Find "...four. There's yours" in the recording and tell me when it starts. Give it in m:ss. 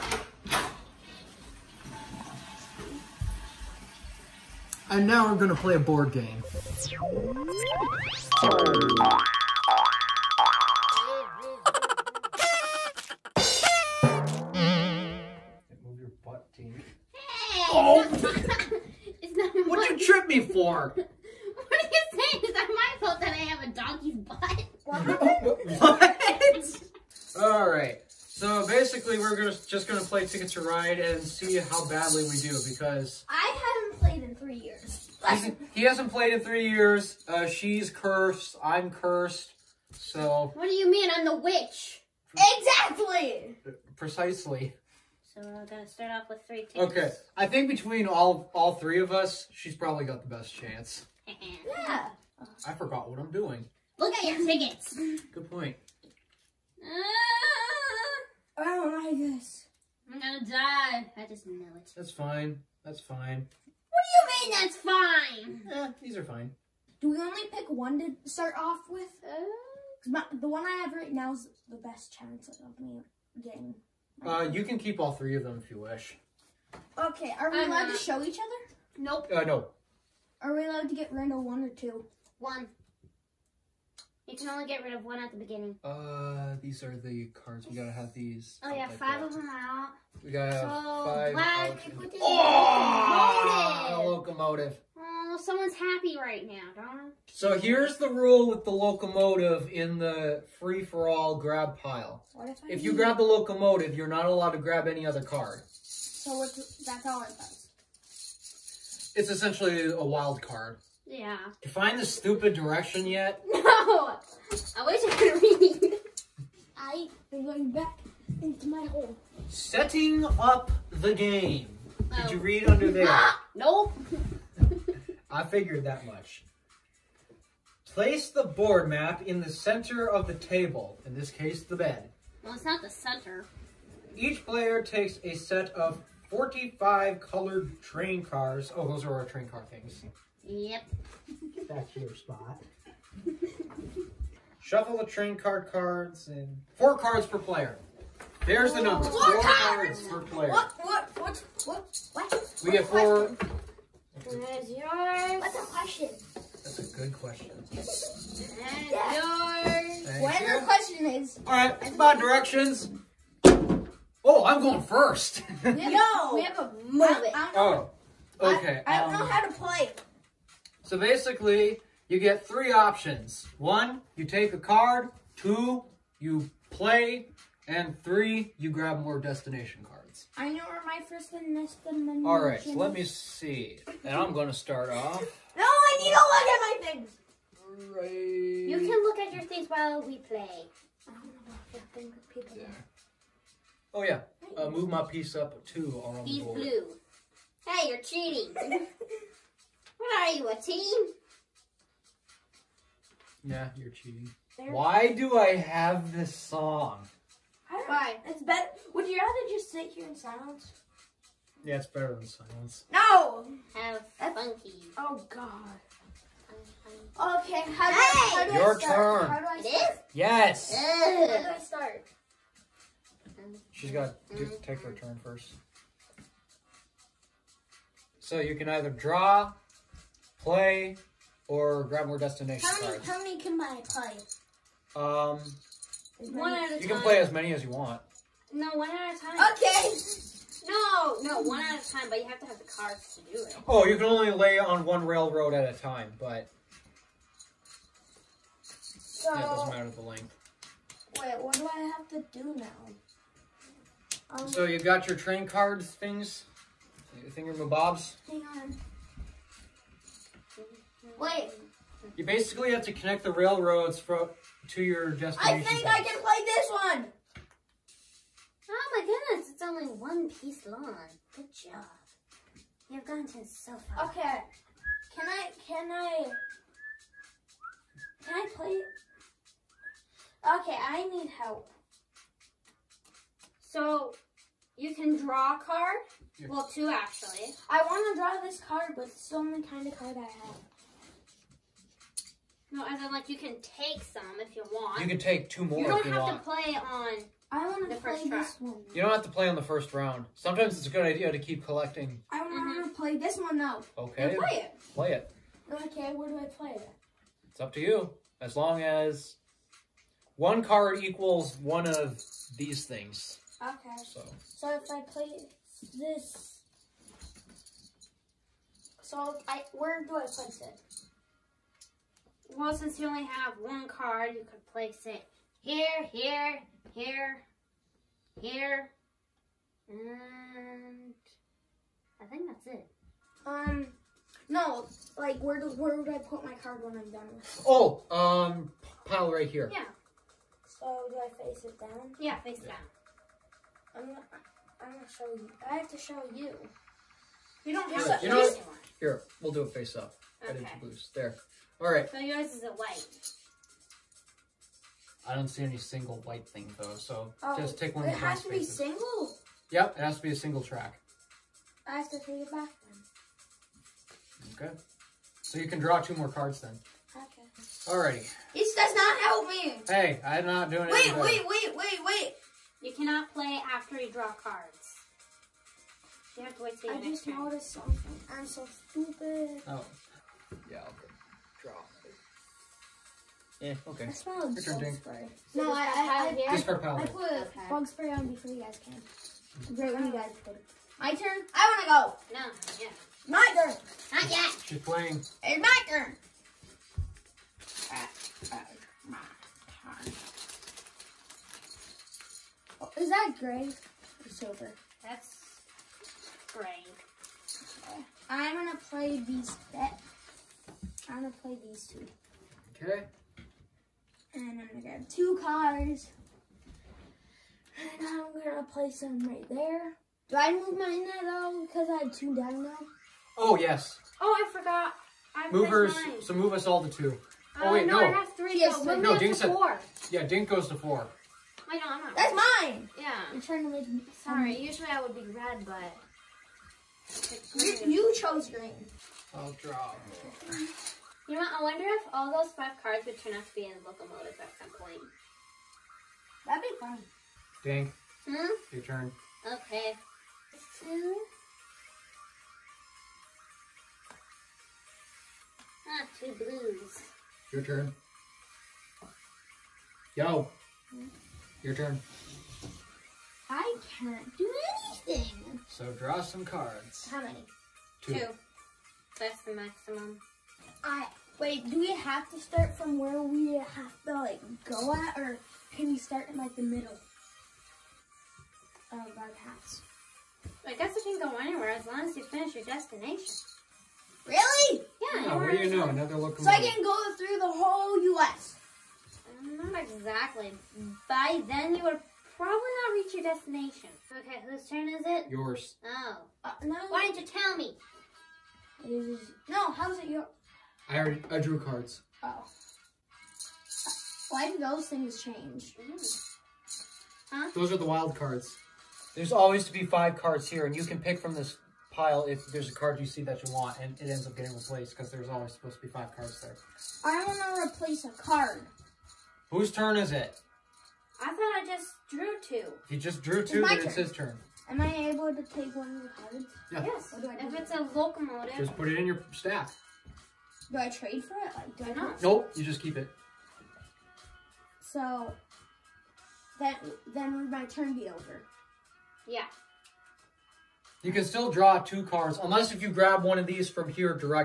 2:32.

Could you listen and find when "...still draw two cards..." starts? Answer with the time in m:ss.
9:01.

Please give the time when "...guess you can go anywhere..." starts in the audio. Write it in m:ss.
8:00.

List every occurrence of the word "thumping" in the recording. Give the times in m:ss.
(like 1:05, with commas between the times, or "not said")
not said.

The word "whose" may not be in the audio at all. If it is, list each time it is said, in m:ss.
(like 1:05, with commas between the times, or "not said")
8:14, 8:39.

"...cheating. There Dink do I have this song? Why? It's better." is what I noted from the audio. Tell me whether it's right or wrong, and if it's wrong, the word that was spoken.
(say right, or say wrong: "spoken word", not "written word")
wrong: "Why", not "Dink".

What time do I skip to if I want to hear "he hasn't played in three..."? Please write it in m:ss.
0:35.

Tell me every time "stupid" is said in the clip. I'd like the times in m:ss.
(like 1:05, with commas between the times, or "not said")
1:52, 6:18.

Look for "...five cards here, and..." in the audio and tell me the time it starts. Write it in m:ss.
8:29.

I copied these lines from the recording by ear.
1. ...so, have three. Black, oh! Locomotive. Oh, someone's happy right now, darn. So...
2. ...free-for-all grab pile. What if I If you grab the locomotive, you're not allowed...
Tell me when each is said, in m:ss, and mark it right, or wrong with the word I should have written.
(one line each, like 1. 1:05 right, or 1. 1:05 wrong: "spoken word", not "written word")
1. 1:30 wrong: "five", not "three"
2. 1:40 right.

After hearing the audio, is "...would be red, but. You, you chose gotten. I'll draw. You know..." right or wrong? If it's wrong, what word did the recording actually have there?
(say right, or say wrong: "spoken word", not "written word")
wrong: "green", not "gotten".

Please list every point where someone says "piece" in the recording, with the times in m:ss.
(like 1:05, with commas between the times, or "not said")
3:15, 4:30.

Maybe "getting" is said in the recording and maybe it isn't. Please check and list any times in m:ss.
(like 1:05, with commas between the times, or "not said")
1:13, 8:34.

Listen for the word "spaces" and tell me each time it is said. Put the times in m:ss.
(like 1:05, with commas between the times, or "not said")
5:58.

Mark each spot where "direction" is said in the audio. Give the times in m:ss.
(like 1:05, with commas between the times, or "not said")
1:52, 2:42.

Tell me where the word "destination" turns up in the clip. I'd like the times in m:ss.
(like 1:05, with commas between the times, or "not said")
2:59, 3:52, 4:25, 8:02, 8:13.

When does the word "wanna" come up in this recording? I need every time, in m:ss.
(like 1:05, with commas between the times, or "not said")
6:31.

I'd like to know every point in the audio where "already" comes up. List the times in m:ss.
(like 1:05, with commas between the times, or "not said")
8:20.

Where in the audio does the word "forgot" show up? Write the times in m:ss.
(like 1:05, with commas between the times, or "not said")
0:52, 7:04.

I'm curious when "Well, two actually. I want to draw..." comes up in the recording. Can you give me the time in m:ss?
4:46.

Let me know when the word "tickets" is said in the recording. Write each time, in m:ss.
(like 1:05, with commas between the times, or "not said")
0:30, 0:46, 0:54.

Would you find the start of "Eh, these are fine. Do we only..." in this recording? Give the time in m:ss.
1:05.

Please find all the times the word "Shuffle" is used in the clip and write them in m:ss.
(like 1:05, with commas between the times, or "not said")
2:24.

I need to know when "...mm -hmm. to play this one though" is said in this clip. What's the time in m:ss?
5:02.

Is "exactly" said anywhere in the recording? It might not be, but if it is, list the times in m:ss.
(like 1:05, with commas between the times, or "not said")
0:42, 8:09.